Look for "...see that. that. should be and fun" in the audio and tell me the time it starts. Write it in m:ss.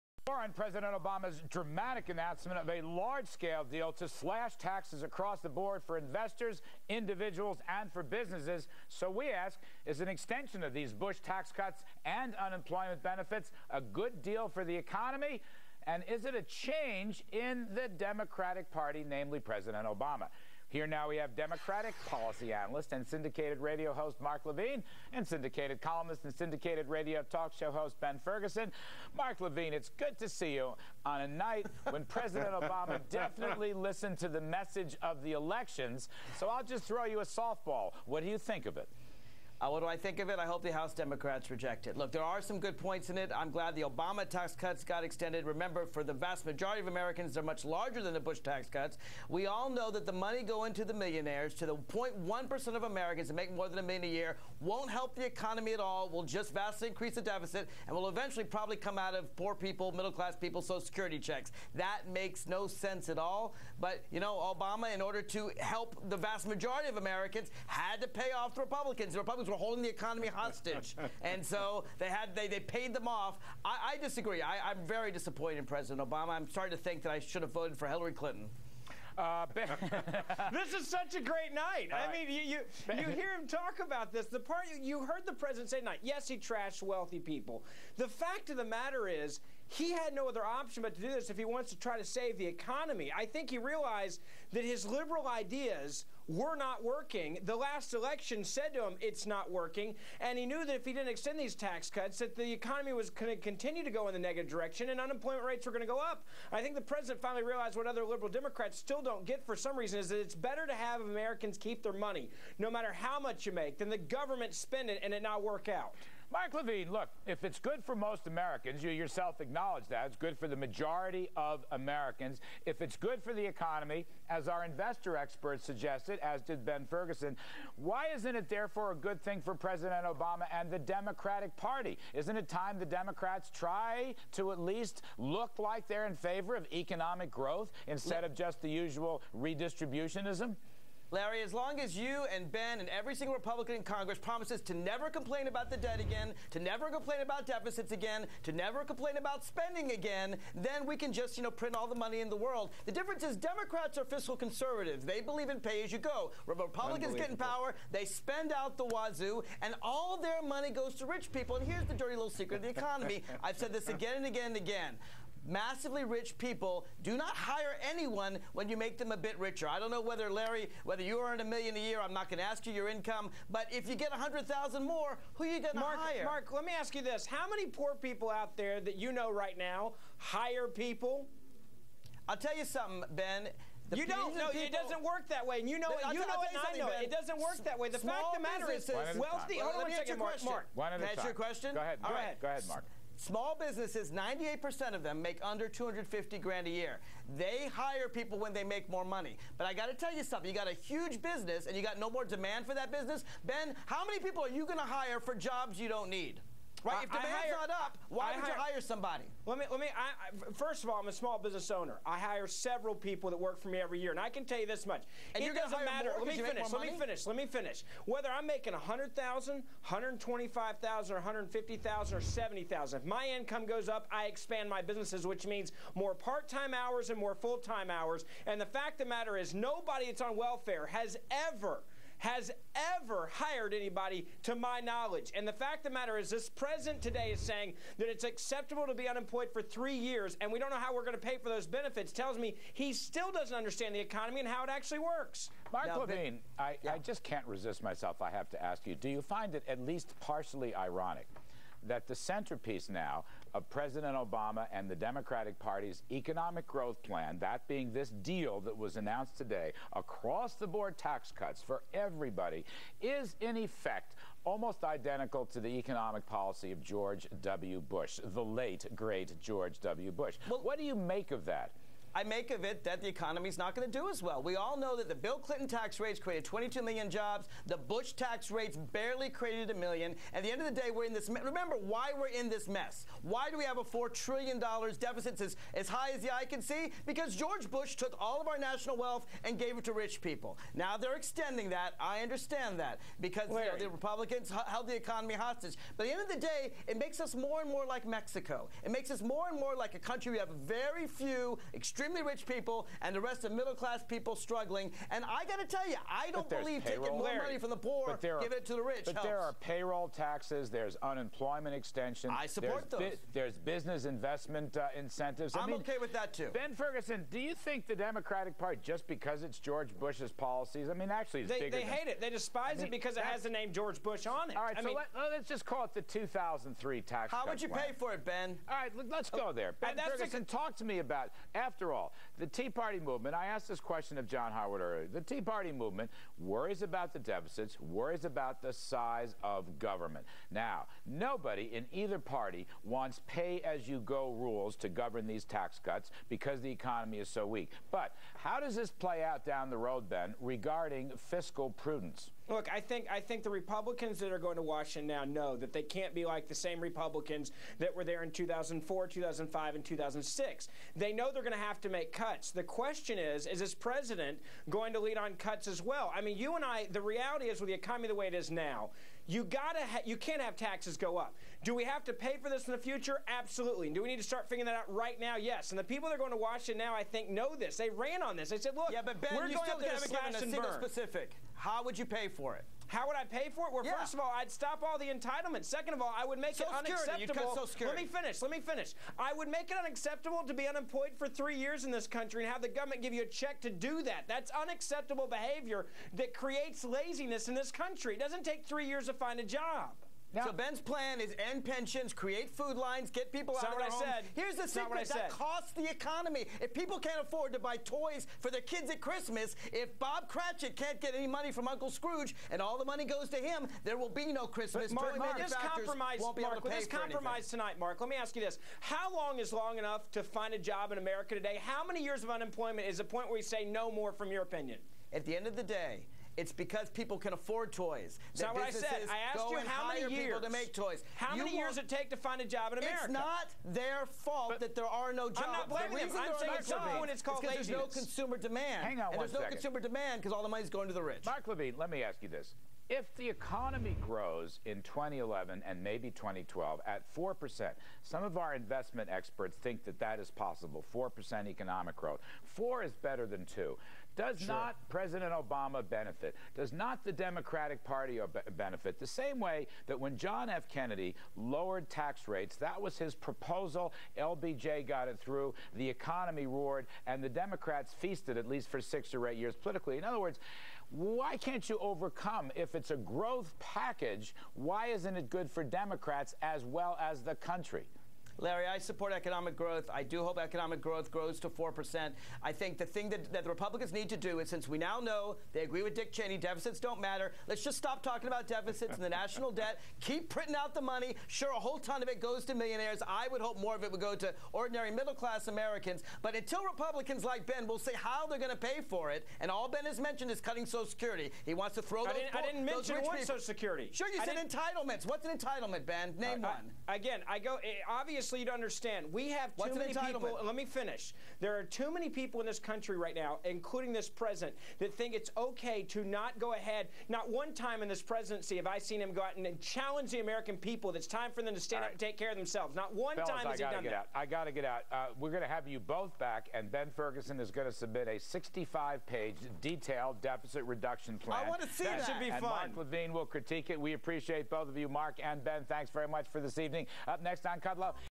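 8:51.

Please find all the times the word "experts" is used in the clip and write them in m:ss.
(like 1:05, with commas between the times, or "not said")
2:05, 7:29.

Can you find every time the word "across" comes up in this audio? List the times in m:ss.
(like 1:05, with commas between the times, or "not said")
0:05, 4:19.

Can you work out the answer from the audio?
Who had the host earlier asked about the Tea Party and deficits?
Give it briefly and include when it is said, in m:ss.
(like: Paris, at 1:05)
John Howard, at 5:34.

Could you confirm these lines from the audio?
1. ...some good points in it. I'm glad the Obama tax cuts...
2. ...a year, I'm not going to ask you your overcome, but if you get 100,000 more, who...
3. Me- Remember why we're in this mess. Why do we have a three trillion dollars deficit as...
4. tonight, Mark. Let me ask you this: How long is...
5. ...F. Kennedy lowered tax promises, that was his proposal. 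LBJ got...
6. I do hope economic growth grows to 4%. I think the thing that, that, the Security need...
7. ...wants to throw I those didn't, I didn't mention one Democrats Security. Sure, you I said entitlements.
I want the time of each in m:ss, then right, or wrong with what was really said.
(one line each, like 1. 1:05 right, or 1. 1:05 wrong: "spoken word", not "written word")
1. 0:42 right
2. 2:51 wrong: "income", not "overcome"
3. 4:41 wrong: "four", not "three"
4. 6:57 right
5. 7:40 wrong: "rates", not "promises"
6. 7:59 wrong: "Republicans", not "Security"
7. 8:21 wrong: "Social", not "Democrats".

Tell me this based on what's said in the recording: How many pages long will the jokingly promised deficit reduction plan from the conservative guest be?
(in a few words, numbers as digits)
65.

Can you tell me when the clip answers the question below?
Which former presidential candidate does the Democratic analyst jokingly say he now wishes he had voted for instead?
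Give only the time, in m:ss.
1:17.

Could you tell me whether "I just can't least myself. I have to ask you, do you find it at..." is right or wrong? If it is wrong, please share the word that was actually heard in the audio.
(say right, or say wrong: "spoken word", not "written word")
wrong: "resist", not "least".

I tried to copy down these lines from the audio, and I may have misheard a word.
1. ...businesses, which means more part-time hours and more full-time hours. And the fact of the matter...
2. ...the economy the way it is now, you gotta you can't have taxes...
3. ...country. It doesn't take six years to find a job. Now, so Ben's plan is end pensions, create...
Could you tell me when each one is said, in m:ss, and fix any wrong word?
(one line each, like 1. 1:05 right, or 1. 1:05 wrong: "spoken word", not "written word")
1. 3:44 right
2. 6:07 right
3. 6:37 wrong: "three", not "six".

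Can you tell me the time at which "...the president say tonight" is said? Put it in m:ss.
1:25.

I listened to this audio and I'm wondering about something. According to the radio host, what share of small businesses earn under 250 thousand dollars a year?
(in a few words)
98%.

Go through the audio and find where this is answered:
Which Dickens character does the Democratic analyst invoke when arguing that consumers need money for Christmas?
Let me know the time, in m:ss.
6:49.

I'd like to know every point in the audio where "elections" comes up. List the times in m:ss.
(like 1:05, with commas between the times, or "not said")
0:35, 1:37.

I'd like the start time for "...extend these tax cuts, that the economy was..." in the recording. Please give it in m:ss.
1:41.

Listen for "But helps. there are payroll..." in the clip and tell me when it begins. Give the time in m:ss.
5:09.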